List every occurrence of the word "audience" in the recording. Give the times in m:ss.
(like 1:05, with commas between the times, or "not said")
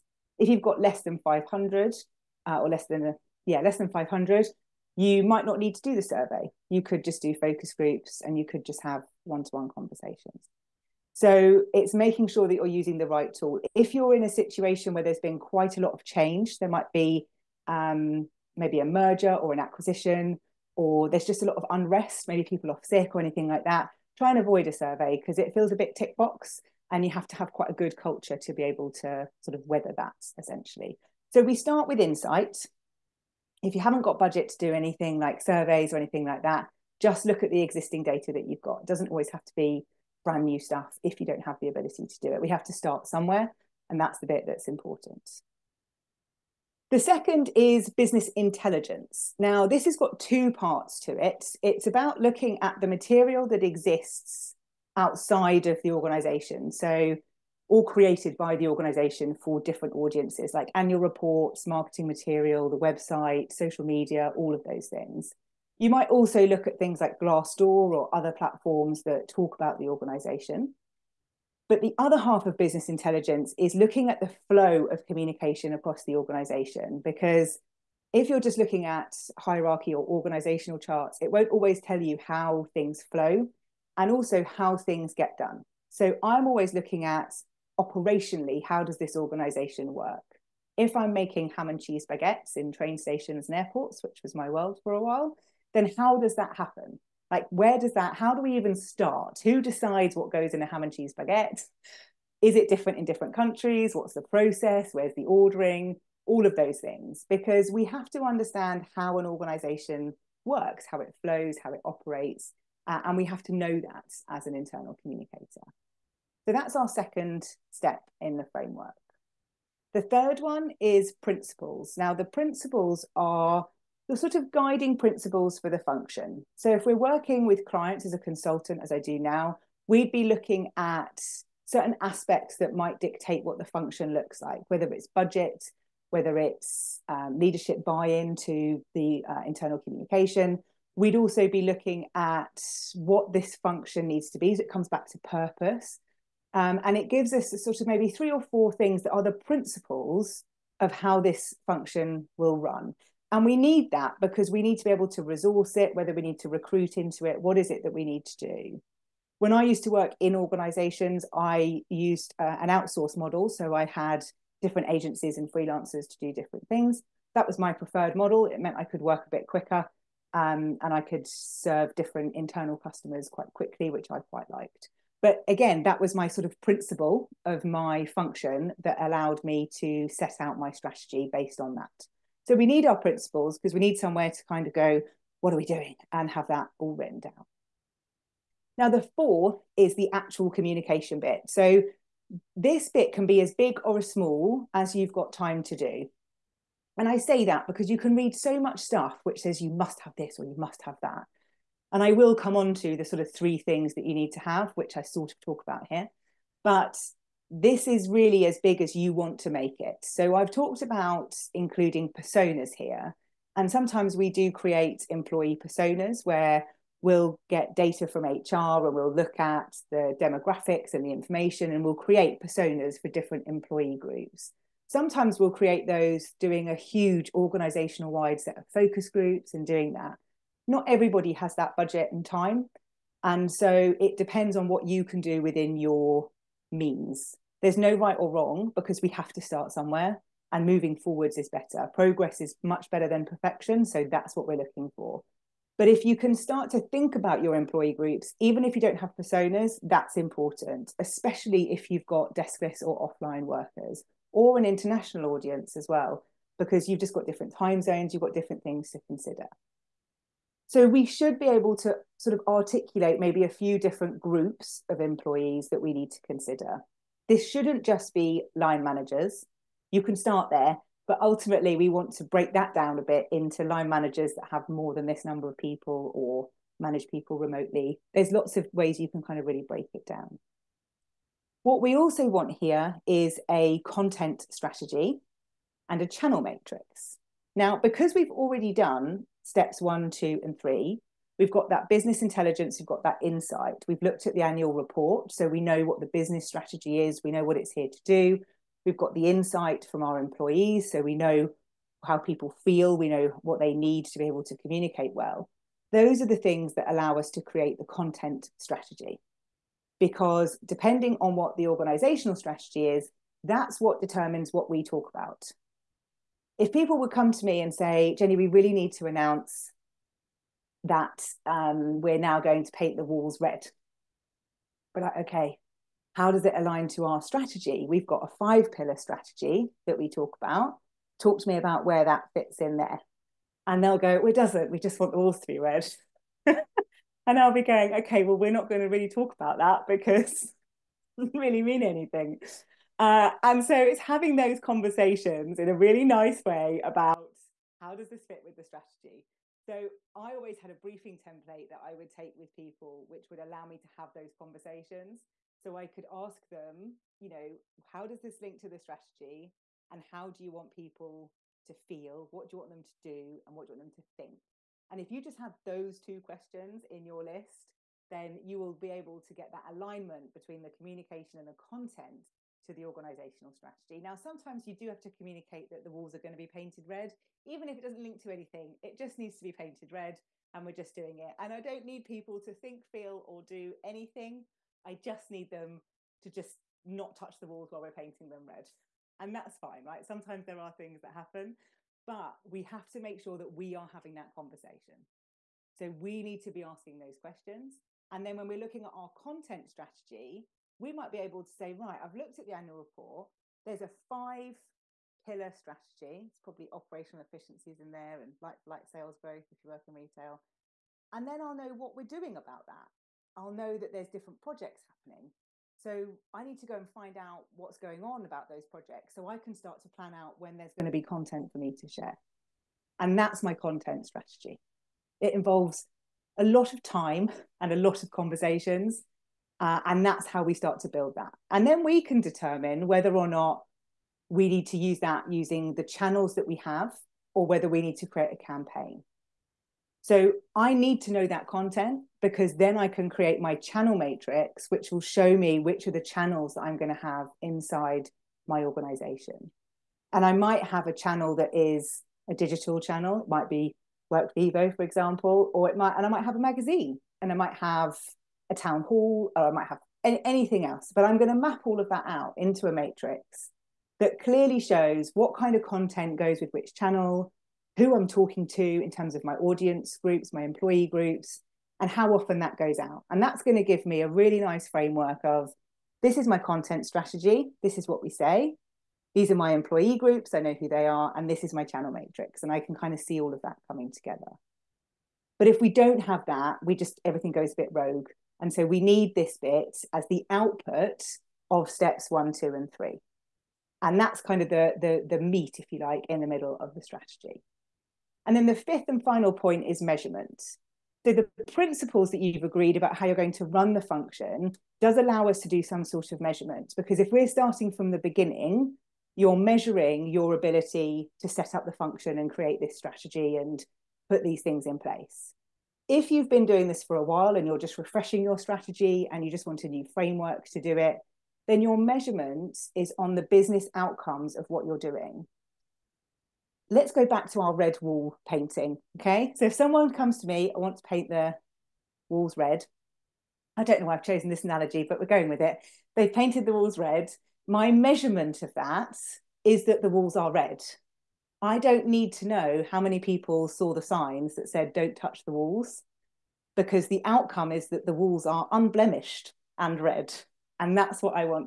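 0:59, 4:15, 7:49.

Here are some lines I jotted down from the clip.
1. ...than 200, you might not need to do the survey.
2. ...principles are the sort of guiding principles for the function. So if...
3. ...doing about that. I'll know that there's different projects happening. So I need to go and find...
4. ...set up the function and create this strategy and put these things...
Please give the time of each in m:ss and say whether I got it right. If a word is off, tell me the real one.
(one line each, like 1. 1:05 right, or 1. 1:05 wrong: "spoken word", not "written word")
1. 0:03 wrong: "500", not "200"
2. 2:02 right
3. 6:52 right
4. 8:31 right.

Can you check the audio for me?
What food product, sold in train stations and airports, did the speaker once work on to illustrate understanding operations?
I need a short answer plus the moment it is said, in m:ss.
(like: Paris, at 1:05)
Ham and cheese baguettes, at 1:31.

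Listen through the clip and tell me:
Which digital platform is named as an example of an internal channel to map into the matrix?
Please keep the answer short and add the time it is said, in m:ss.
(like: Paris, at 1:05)
Workvivo, at 7:34.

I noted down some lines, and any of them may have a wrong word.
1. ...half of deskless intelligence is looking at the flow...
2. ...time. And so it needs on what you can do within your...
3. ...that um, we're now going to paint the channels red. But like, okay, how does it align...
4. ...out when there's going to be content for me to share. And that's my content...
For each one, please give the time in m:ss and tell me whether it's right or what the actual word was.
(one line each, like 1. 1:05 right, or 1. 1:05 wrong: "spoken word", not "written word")
1. 1:12 wrong: "business", not "deskless"
2. 3:52 wrong: "depends", not "needs"
3. 5:20 wrong: "walls", not "channels"
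4. 7:00 right.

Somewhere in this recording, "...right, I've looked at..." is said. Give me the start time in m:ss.
6:41.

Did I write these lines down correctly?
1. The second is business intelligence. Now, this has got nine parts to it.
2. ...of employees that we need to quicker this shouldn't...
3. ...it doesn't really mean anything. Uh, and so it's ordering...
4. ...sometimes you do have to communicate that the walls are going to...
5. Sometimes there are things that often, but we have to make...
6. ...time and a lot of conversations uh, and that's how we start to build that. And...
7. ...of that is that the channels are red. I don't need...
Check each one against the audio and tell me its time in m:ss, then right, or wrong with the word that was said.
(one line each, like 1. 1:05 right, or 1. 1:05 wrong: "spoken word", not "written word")
1. 0:46 wrong: "two", not "nine"
2. 4:24 wrong: "consider", not "quicker"
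3. 5:41 wrong: "having", not "ordering"
4. 6:14 right
5. 6:30 wrong: "happen", not "often"
6. 7:06 right
7. 8:58 wrong: "walls", not "channels".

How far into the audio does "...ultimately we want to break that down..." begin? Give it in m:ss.
4:31.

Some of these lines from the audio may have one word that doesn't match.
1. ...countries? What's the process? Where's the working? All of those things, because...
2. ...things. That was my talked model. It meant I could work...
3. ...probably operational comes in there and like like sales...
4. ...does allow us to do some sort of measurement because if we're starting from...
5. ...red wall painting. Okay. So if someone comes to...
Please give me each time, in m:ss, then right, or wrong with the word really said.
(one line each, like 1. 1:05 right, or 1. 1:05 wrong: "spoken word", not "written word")
1. 1:43 wrong: "ordering", not "working"
2. 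2:46 wrong: "preferred", not "talked"
3. 6:46 wrong: "efficiencies", not "comes"
4. 8:24 right
5. 8:47 right.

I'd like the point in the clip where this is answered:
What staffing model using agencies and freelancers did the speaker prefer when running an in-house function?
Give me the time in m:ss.
2:42.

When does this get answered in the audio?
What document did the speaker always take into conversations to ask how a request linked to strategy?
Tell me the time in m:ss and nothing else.
5:50.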